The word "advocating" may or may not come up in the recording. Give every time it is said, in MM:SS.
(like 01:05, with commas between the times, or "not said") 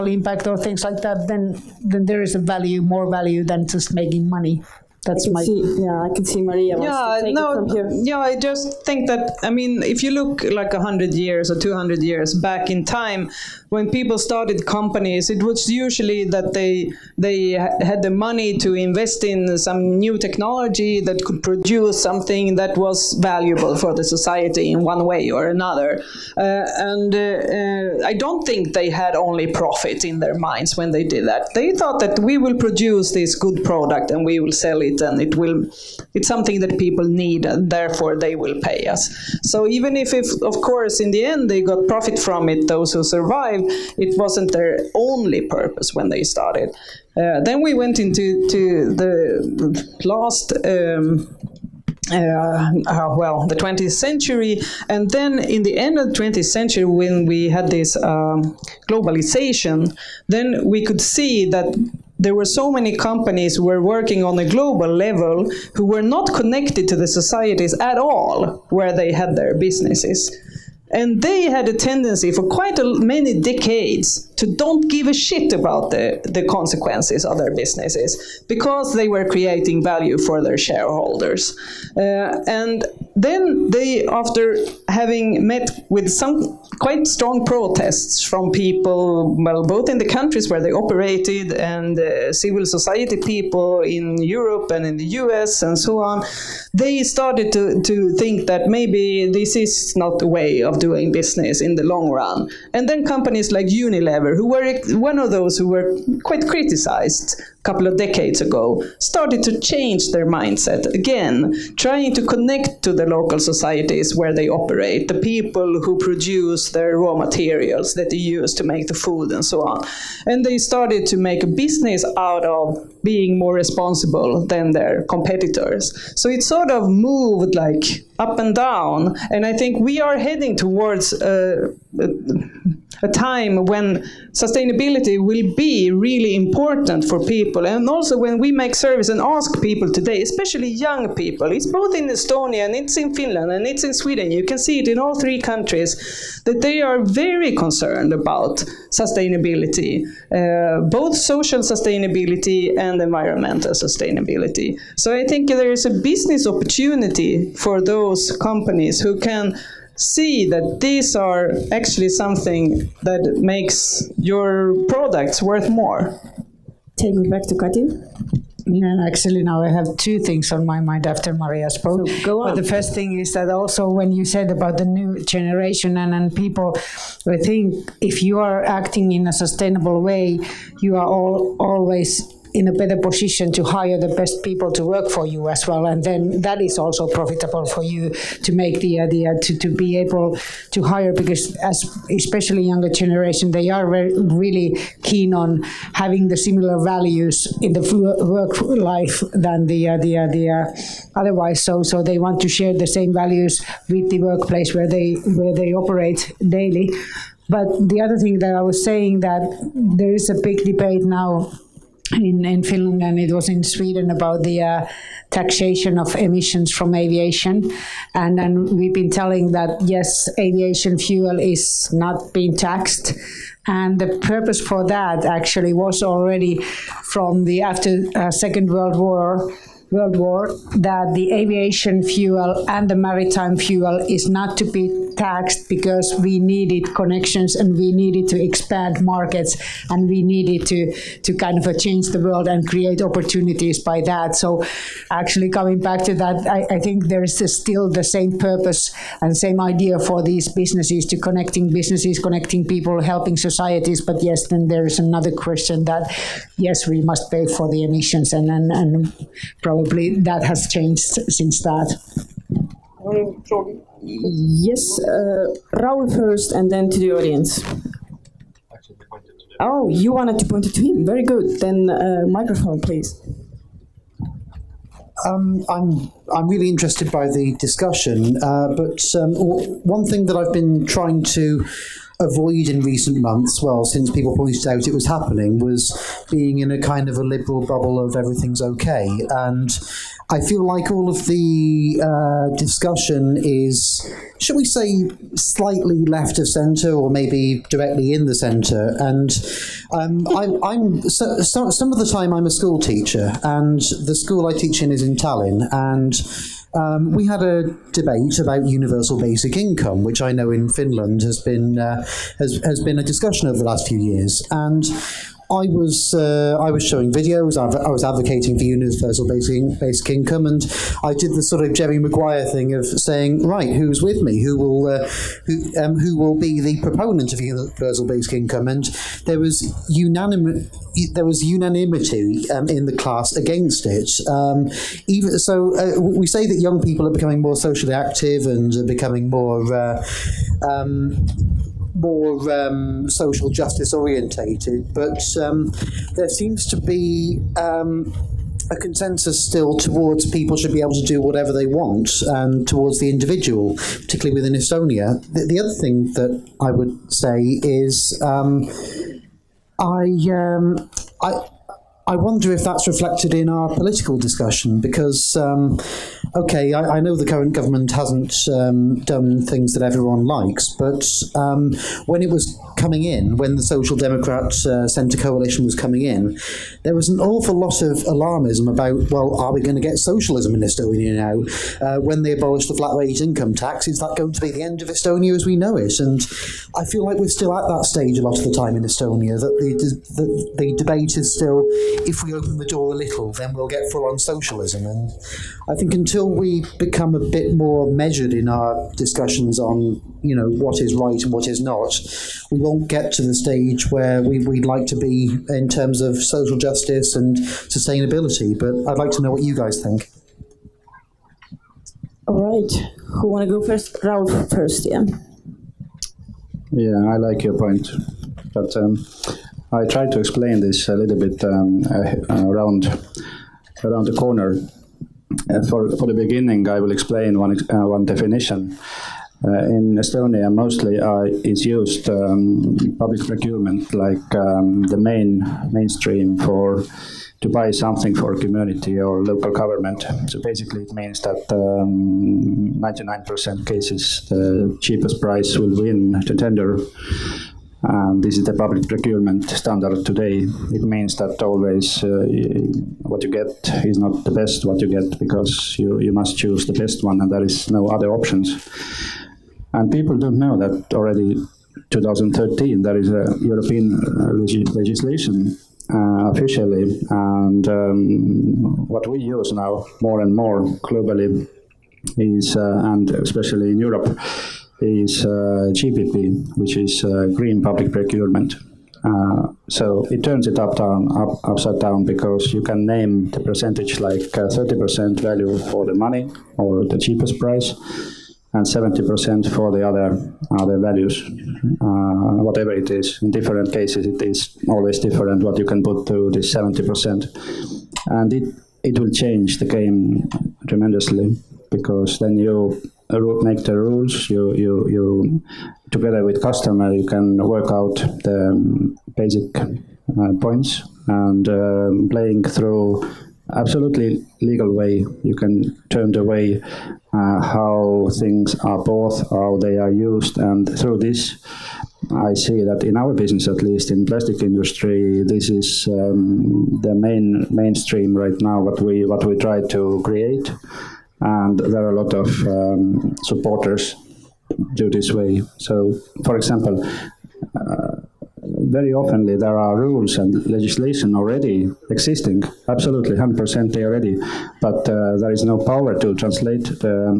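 05:18.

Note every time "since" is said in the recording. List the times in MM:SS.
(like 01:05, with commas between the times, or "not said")
04:21, 04:43.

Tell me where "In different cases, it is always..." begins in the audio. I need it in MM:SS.
08:13.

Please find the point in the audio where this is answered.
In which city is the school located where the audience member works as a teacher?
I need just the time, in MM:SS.
05:05.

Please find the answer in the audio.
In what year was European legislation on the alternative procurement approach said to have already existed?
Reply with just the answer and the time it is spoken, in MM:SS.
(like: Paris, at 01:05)
2013, at 07:41.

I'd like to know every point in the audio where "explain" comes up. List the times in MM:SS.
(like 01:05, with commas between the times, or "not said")
07:00, 07:06.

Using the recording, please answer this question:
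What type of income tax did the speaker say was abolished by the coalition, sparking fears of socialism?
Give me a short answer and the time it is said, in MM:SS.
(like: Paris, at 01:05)
Flat rate income tax, at 06:22.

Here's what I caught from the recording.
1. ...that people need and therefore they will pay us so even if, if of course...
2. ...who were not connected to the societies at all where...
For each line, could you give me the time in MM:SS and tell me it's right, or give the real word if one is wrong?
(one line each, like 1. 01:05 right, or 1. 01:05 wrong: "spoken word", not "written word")
1. 00:36 right
2. 01:05 right.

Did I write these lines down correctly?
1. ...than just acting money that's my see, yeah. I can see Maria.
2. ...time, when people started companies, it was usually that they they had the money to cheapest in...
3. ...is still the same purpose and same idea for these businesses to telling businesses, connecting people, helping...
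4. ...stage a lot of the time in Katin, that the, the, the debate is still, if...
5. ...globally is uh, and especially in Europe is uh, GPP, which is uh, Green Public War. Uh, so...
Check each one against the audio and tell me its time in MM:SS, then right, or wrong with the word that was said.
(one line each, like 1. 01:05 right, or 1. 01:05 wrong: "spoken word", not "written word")
1. 00:03 wrong: "making", not "acting"
2. 00:12 wrong: "invest", not "cheapest"
3. 04:07 wrong: "connecting", not "telling"
4. 06:27 wrong: "Estonia", not "Katin"
5. 07:50 wrong: "Procurement", not "War".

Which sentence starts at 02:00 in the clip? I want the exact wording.
And they started to make a business out of being more responsible than their competitors.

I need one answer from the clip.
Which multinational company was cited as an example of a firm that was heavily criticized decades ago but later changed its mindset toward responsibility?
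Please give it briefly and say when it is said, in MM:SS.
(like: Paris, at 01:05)
Unilever, at 01:43.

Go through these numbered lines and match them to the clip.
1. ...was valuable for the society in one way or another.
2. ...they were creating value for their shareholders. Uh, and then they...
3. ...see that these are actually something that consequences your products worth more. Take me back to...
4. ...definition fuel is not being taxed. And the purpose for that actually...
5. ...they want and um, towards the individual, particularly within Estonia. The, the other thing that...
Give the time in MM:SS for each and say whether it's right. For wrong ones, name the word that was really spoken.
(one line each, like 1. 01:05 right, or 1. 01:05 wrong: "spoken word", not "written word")
1. 00:22 right
2. 01:18 right
3. 02:39 wrong: "makes", not "consequences"
4. 03:40 wrong: "aviation", not "definition"
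5. 05:51 right.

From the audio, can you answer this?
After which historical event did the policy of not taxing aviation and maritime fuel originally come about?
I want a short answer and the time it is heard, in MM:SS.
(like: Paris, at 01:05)
Second World War, at 03:48.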